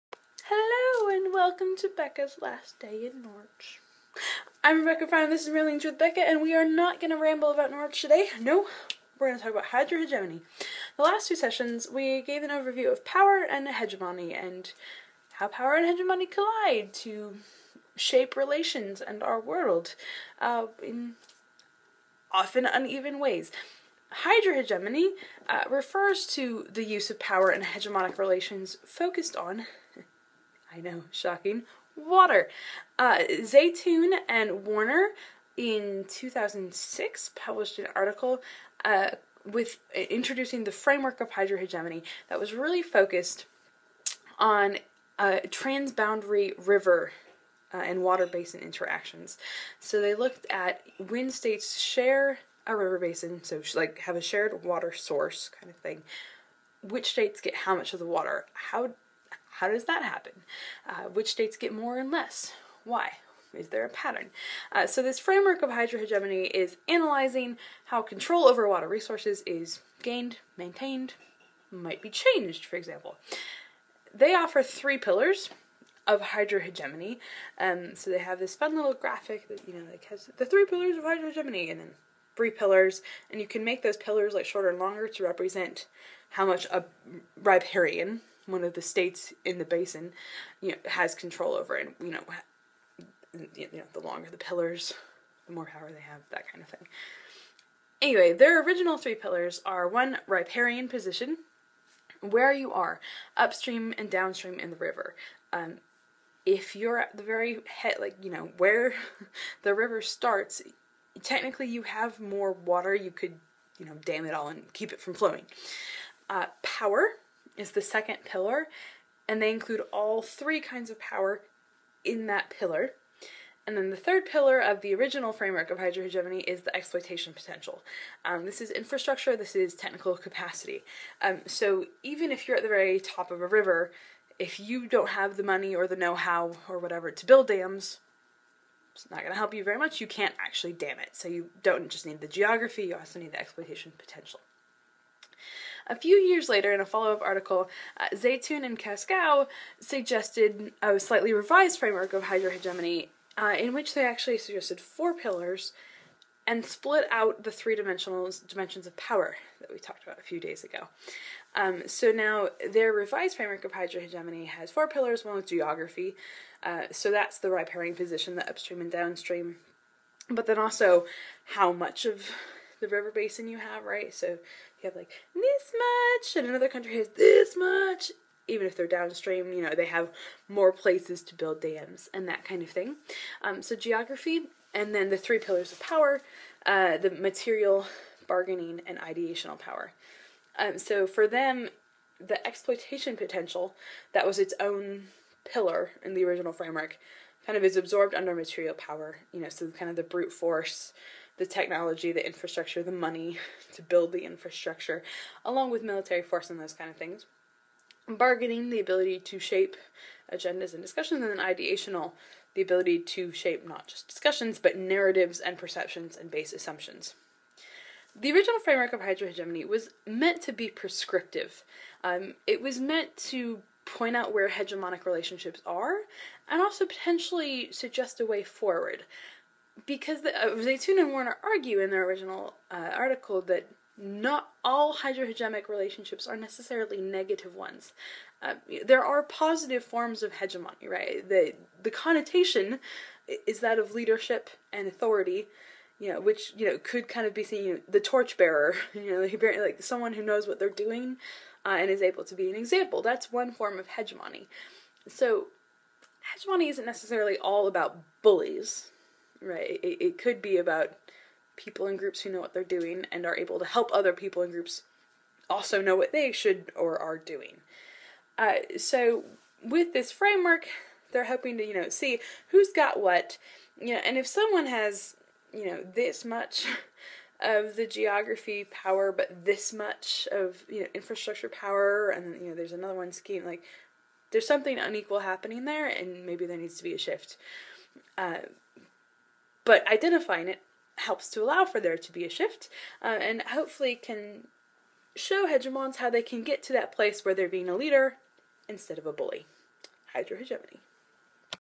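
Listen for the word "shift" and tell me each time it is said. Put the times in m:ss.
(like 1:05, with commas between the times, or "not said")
4:46, 4:52.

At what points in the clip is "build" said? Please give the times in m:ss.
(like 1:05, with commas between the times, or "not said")
2:17, 3:01, 3:23.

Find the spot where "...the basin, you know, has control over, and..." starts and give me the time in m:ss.
1:29.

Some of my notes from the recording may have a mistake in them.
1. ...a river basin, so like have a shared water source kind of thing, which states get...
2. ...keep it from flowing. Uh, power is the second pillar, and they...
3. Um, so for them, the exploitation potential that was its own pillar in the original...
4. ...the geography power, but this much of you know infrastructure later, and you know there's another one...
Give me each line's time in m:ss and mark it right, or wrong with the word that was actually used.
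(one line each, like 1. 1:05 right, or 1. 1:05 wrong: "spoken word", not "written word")
1. 0:52 right
2. 1:54 right
3. 3:10 right
4. 4:37 wrong: "power", not "later".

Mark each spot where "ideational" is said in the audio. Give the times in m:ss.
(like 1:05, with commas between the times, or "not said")
3:08, 3:31.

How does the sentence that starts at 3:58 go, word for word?
Uh, there are positive forms of hegemony, right?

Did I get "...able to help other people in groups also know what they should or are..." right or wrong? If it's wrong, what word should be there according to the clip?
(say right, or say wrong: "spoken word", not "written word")
right.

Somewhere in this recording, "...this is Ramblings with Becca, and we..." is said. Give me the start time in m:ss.
0:05.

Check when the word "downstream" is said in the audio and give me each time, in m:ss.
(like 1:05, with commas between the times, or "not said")
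1:44, 2:48, 2:58.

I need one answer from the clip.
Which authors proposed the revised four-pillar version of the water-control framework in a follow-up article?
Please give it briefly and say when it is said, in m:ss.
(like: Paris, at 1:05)
Zeitoun and Cascão, at 2:28.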